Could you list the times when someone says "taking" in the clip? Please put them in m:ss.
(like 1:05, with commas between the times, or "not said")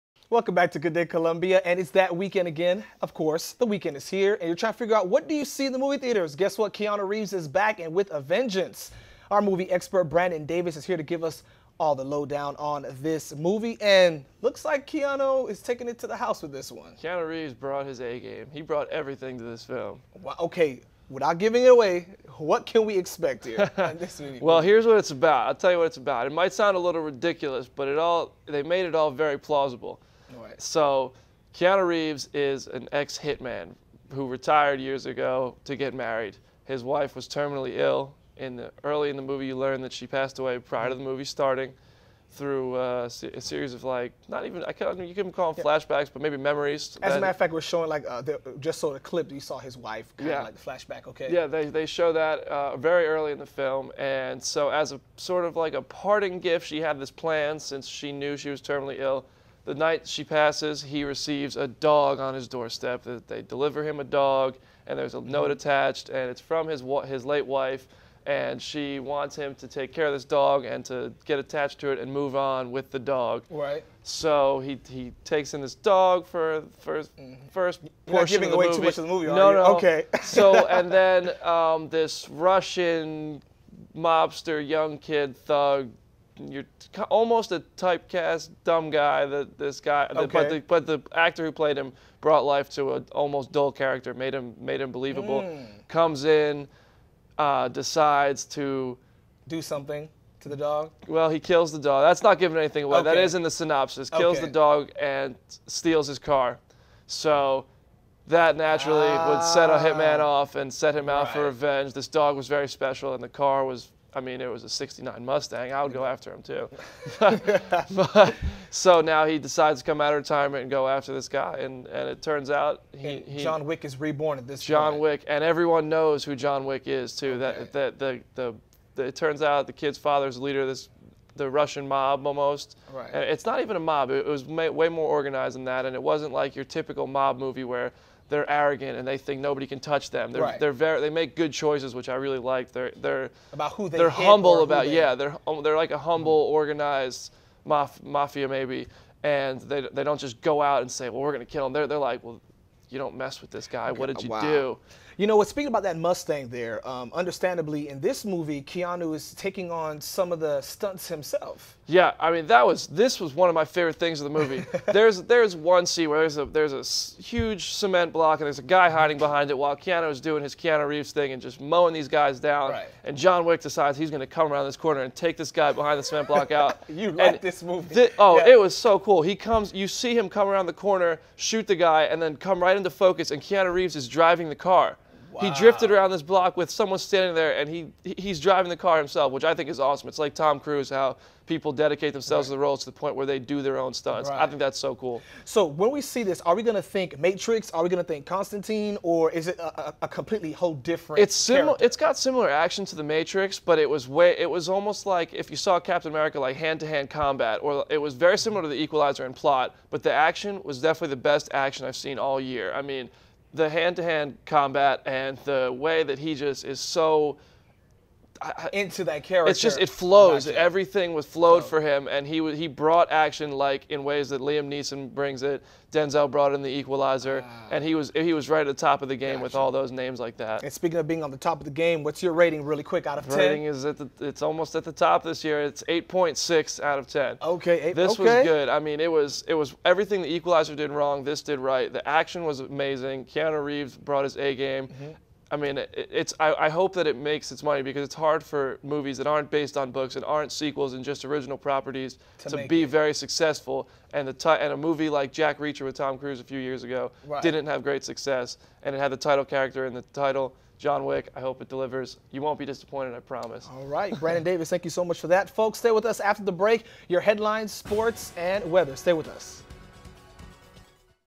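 0:15, 2:39.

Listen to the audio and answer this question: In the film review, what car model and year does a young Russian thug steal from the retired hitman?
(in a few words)
69 Mustang.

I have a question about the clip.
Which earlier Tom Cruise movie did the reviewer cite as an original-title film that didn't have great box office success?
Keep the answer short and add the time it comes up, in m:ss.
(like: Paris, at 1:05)
Jack Reacher, at 4:15.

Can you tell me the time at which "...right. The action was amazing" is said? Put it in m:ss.
4:01.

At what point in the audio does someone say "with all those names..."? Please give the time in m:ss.
3:49.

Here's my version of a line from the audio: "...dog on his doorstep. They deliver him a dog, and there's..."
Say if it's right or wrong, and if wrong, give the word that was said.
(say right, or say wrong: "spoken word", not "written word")
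right.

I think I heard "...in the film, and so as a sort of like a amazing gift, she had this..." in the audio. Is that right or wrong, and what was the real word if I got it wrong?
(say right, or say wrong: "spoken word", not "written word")
wrong: "parting", not "amazing".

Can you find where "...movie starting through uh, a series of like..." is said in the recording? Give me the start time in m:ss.
0:41.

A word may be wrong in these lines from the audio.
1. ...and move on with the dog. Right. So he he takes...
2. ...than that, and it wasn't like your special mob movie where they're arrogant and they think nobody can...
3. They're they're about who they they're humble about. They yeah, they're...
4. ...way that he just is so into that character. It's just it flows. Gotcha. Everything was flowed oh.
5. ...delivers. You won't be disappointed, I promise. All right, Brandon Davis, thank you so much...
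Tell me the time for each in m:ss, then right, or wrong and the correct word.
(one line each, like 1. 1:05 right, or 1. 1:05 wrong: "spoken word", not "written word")
1. 1:11 right
2. 2:15 wrong: "typical", not "special"
3. 2:22 right
4. 3:35 right
5. 4:21 right.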